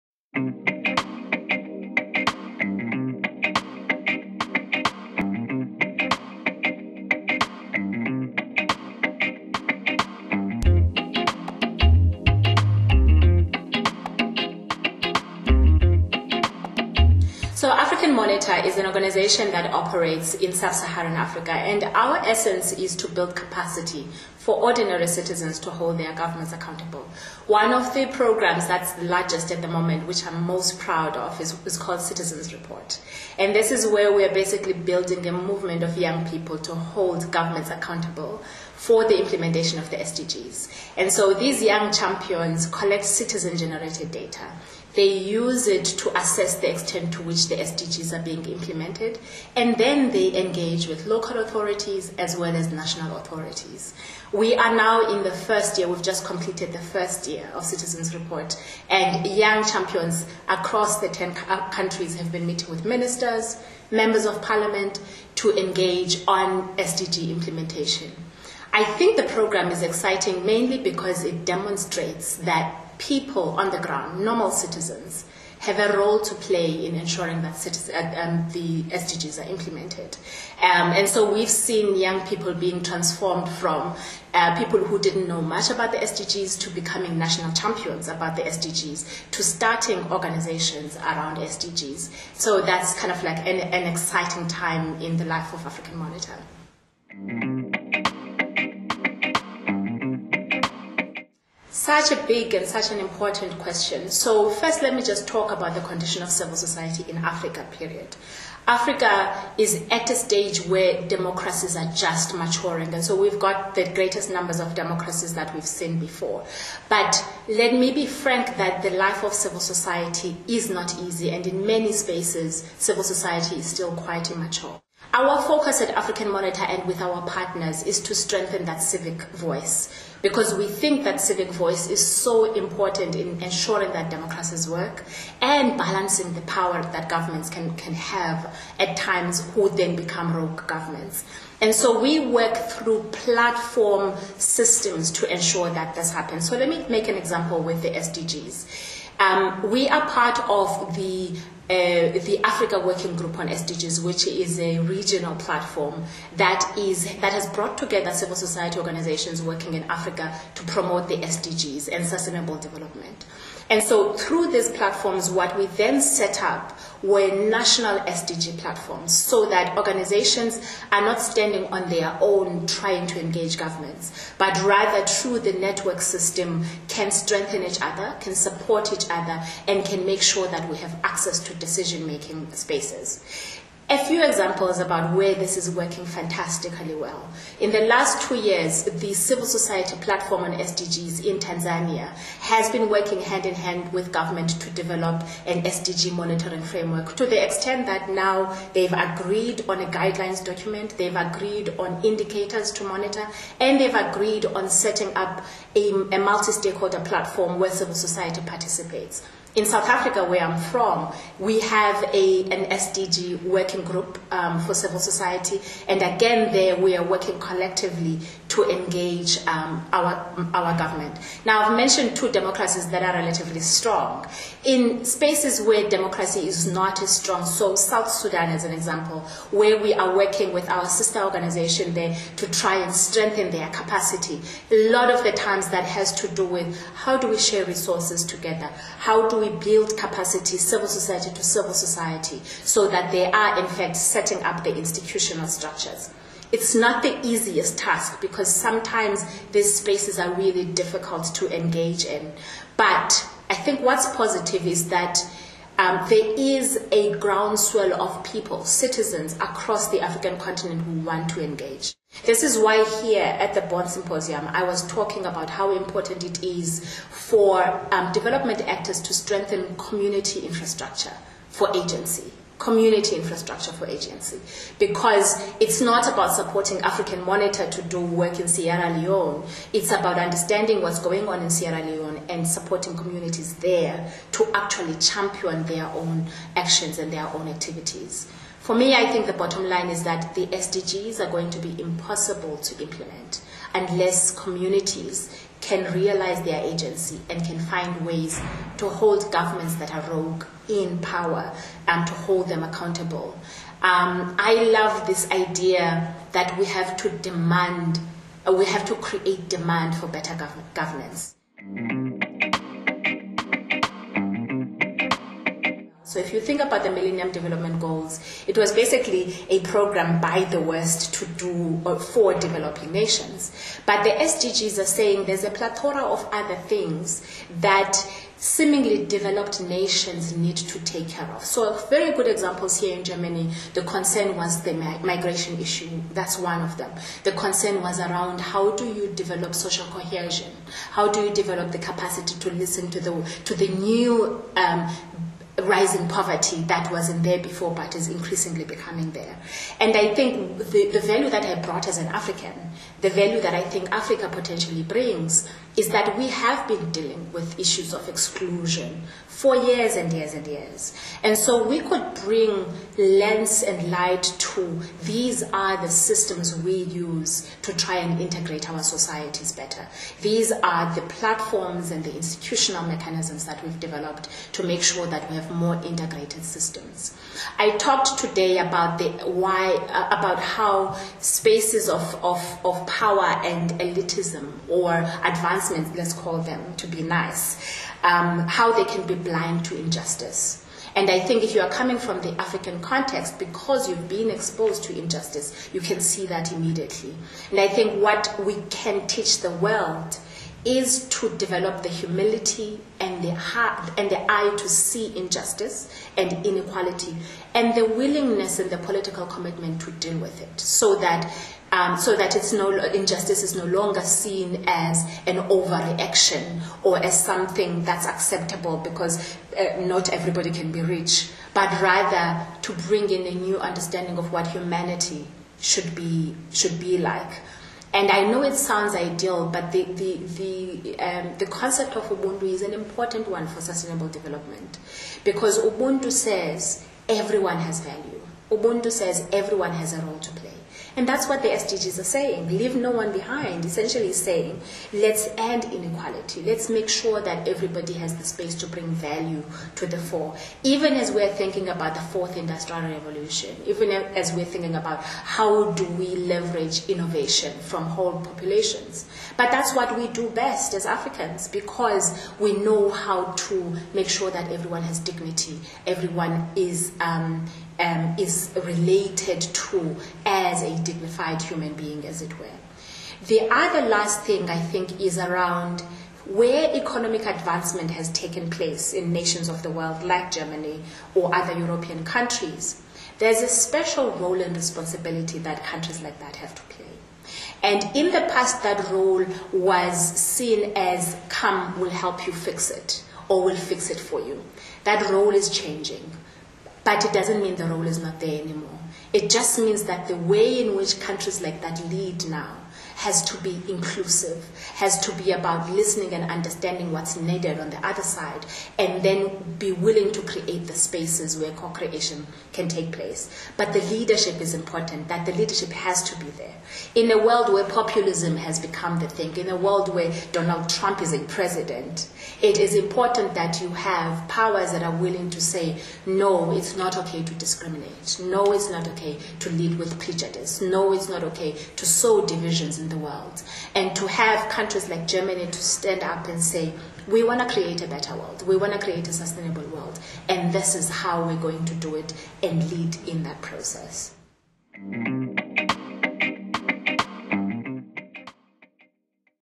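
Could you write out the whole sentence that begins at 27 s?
One of the programs that's the largest at the moment, which I'm most proud of, is, is called Citizens Report.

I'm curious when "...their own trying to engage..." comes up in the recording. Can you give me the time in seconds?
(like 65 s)
171 s.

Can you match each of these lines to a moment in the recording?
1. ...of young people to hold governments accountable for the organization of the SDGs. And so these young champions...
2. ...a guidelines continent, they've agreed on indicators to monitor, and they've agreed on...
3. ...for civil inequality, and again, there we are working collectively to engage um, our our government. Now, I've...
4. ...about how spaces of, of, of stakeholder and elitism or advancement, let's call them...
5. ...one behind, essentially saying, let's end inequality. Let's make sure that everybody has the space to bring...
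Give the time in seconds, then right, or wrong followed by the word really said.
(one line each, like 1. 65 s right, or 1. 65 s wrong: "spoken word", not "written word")
1. 35 s wrong: "implementation", not "organization"
2. 199 s wrong: "document", not "continent"
3. 214 s wrong: "society", not "inequality"
4. 380 s wrong: "power", not "stakeholder"
5. 442 s right.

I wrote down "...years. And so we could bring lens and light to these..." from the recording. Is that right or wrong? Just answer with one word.
right.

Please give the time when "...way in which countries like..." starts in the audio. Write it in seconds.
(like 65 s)
500 s.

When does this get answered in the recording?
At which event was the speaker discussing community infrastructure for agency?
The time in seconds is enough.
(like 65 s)
263 s.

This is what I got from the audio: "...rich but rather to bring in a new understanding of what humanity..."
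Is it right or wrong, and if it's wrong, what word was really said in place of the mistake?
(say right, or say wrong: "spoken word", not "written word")
right.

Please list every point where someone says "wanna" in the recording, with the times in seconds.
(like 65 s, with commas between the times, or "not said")
not said.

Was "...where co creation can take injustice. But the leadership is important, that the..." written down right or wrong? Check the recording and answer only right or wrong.
wrong.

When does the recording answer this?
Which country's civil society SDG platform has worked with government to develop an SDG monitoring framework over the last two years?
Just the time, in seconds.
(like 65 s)
191 s.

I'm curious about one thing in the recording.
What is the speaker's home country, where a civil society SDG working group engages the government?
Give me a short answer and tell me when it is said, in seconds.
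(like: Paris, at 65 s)
South Africa, at 209 s.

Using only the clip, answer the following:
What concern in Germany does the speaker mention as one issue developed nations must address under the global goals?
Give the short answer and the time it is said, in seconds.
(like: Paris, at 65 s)
Migration, at 334 s.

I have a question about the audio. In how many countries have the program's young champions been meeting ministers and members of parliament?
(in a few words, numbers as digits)
10.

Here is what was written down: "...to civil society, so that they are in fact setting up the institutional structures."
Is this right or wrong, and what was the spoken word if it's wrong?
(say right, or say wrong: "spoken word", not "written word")
right.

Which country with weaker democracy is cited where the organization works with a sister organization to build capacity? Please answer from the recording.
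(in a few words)
South Sudan.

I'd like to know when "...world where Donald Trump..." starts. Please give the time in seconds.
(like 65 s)
519 s.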